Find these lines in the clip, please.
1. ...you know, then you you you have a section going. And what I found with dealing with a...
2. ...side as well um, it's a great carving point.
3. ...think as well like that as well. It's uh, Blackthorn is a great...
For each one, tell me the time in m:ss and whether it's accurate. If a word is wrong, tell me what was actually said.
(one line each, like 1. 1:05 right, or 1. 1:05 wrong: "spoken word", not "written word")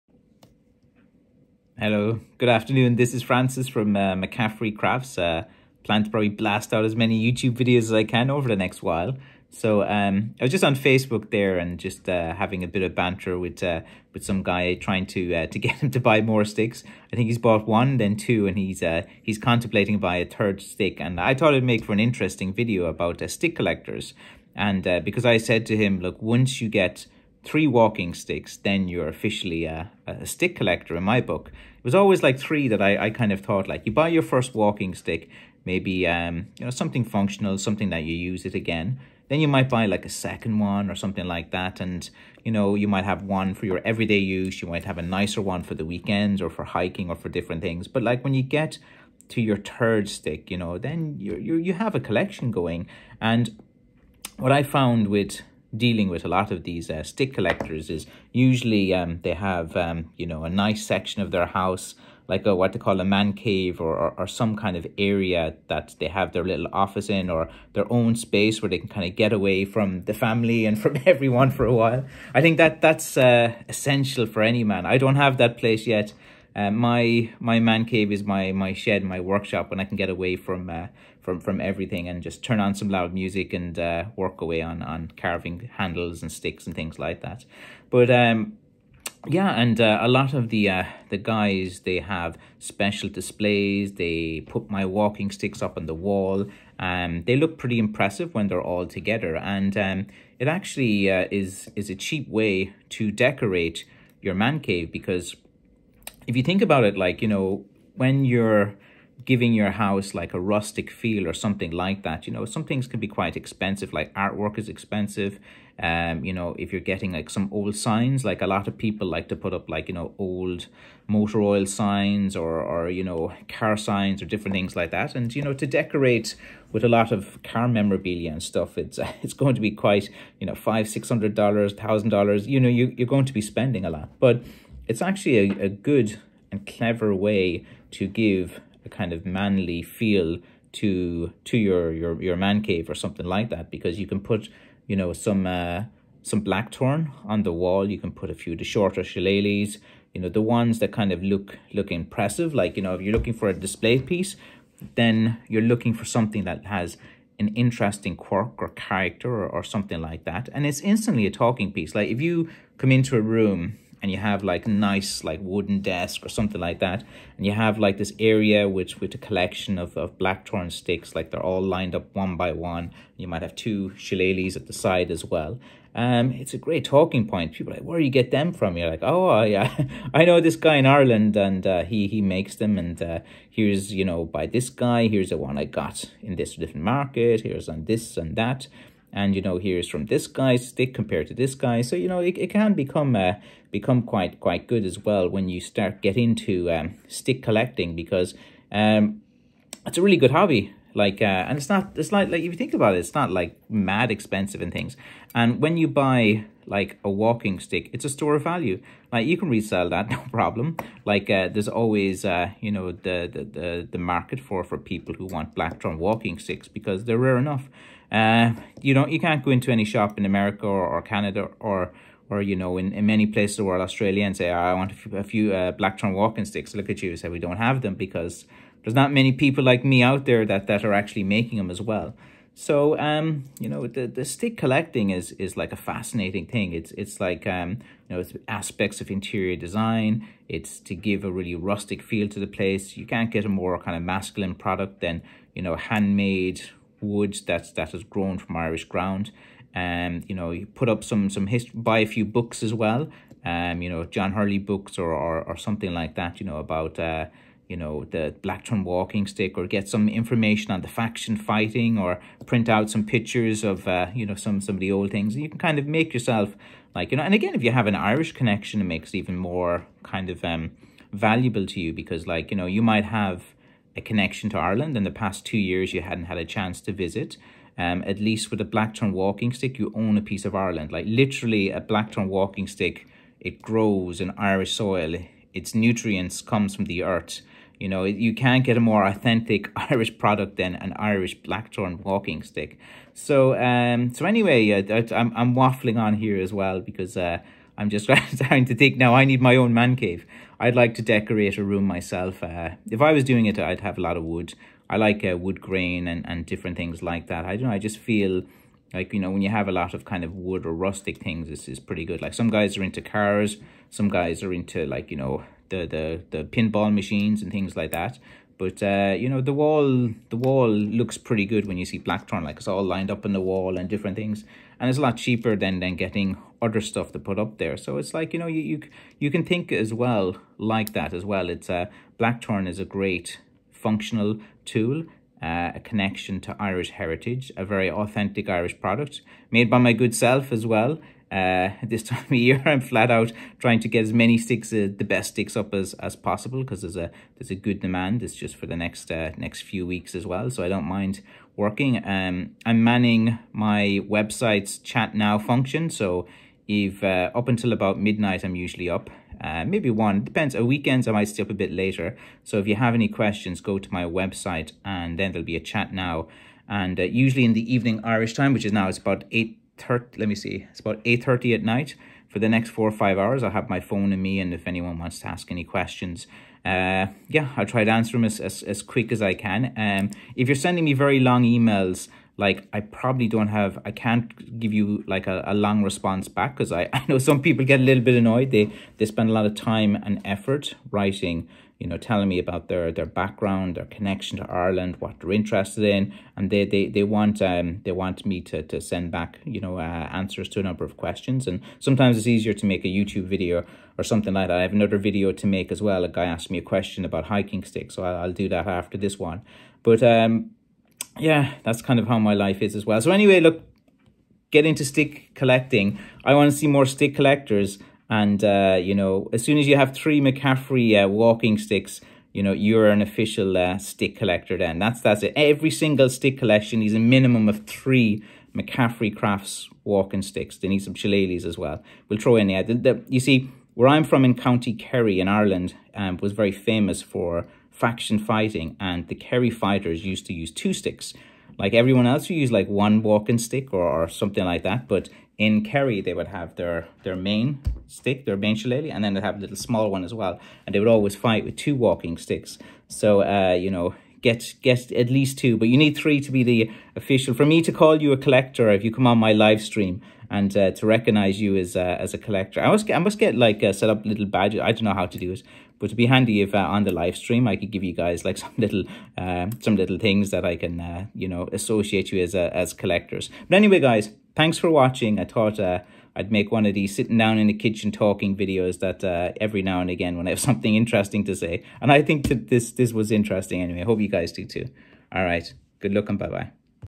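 1. 0:50 wrong: "collection", not "section"
2. 2:54 wrong: "talking", not "carving"
3. 5:29 right.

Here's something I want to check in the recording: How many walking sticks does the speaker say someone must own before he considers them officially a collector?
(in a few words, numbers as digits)
3.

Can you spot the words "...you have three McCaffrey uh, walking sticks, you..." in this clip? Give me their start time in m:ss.
6:59.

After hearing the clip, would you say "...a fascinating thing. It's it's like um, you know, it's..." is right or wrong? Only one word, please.
right.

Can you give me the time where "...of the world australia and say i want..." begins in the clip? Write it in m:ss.
3:43.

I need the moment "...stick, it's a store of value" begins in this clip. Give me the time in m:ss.
3:27.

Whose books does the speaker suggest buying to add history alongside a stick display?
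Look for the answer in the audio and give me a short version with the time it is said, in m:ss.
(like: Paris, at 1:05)
John Hurley, at 4:14.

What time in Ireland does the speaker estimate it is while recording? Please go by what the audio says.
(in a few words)
8:30 at night.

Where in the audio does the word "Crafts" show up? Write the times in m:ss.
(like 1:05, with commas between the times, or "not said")
0:04, 7:09.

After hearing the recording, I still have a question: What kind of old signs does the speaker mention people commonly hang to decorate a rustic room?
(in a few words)
motor oil signs.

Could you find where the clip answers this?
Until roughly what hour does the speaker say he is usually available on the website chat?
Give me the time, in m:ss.
5:57.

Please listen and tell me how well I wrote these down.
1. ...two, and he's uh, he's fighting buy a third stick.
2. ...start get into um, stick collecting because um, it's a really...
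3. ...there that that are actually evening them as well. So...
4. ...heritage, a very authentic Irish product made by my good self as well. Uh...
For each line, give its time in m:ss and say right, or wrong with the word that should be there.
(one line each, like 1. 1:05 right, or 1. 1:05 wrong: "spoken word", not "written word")
1. 0:18 wrong: "contemplating", not "fighting"
2. 3:15 right
3. 3:50 wrong: "making", not "evening"
4. 5:36 right.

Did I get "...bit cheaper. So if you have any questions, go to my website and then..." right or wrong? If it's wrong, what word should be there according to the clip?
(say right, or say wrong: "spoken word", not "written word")
wrong: "later", not "cheaper".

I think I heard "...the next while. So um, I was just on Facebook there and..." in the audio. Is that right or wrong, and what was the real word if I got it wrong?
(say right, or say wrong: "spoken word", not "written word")
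right.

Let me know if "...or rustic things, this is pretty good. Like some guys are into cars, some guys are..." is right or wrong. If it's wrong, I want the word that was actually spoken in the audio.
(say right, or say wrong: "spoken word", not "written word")
right.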